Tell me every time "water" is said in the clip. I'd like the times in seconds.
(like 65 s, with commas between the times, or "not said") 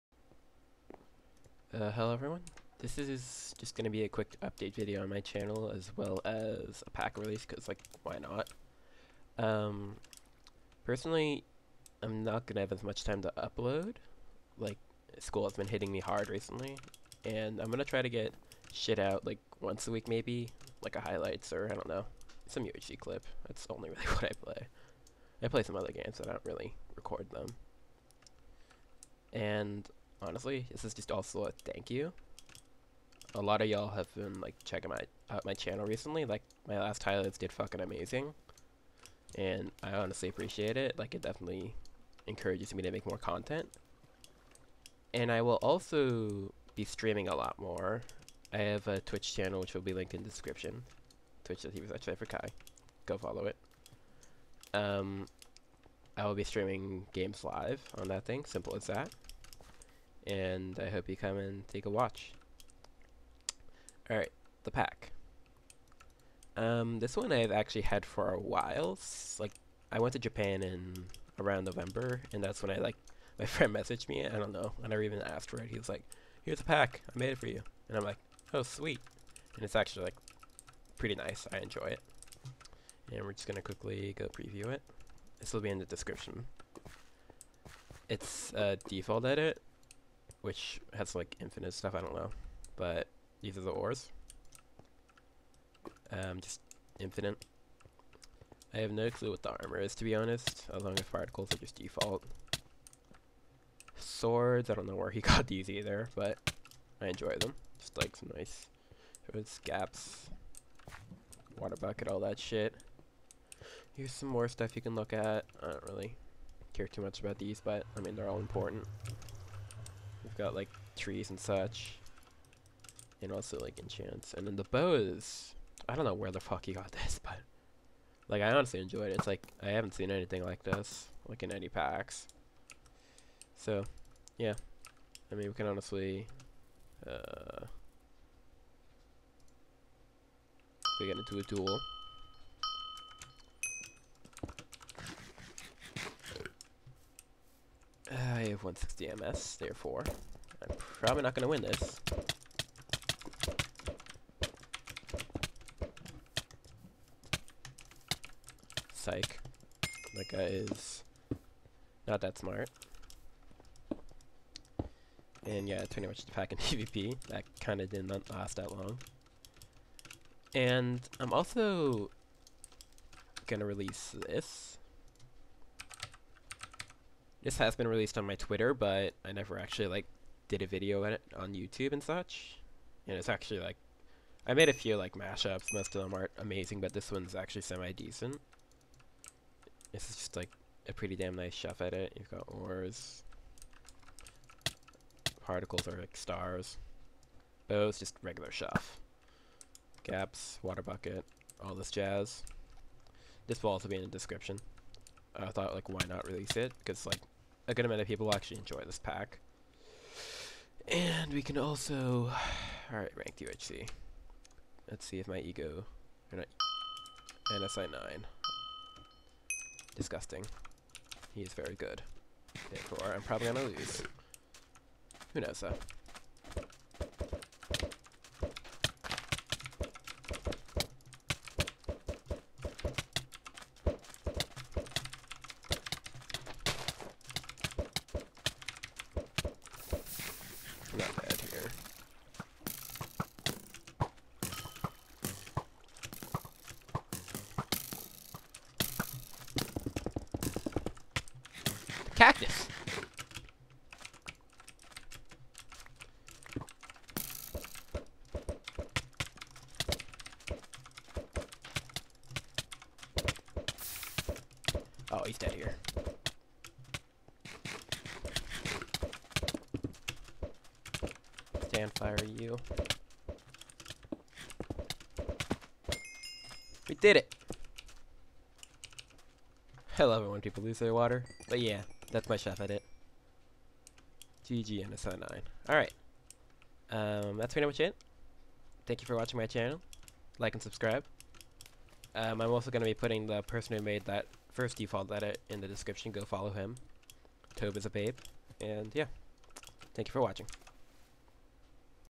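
111 s, 200 s, 280 s.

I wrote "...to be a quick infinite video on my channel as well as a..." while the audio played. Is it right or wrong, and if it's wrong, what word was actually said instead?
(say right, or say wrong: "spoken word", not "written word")
wrong: "update", not "infinite".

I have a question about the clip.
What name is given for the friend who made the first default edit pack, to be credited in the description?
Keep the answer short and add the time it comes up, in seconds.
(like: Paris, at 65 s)
Tobe, at 297 s.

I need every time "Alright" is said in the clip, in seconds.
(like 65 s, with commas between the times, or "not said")
64 s, 212 s, 285 s.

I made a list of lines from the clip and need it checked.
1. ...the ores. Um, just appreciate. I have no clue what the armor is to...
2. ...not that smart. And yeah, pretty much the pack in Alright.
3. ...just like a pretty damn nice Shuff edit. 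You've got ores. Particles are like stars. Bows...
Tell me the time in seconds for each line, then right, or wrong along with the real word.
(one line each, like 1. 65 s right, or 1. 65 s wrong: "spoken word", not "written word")
1. 93 s wrong: "infinite", not "appreciate"
2. 162 s wrong: "PvP", not "Alright"
3. 190 s right.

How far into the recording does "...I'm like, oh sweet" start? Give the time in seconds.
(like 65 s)
77 s.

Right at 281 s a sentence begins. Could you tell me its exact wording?
But yeah, that's my Shuff edit.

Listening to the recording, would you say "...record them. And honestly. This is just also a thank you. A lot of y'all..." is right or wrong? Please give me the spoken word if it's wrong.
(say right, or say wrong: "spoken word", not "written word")
right.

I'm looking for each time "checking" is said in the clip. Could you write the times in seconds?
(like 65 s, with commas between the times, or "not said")
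34 s.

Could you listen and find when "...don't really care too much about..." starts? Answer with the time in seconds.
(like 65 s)
115 s.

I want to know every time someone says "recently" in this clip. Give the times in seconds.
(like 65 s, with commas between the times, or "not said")
16 s, 35 s.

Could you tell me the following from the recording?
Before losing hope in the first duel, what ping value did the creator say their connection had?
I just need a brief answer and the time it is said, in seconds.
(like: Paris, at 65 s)
160 MS, at 148 s.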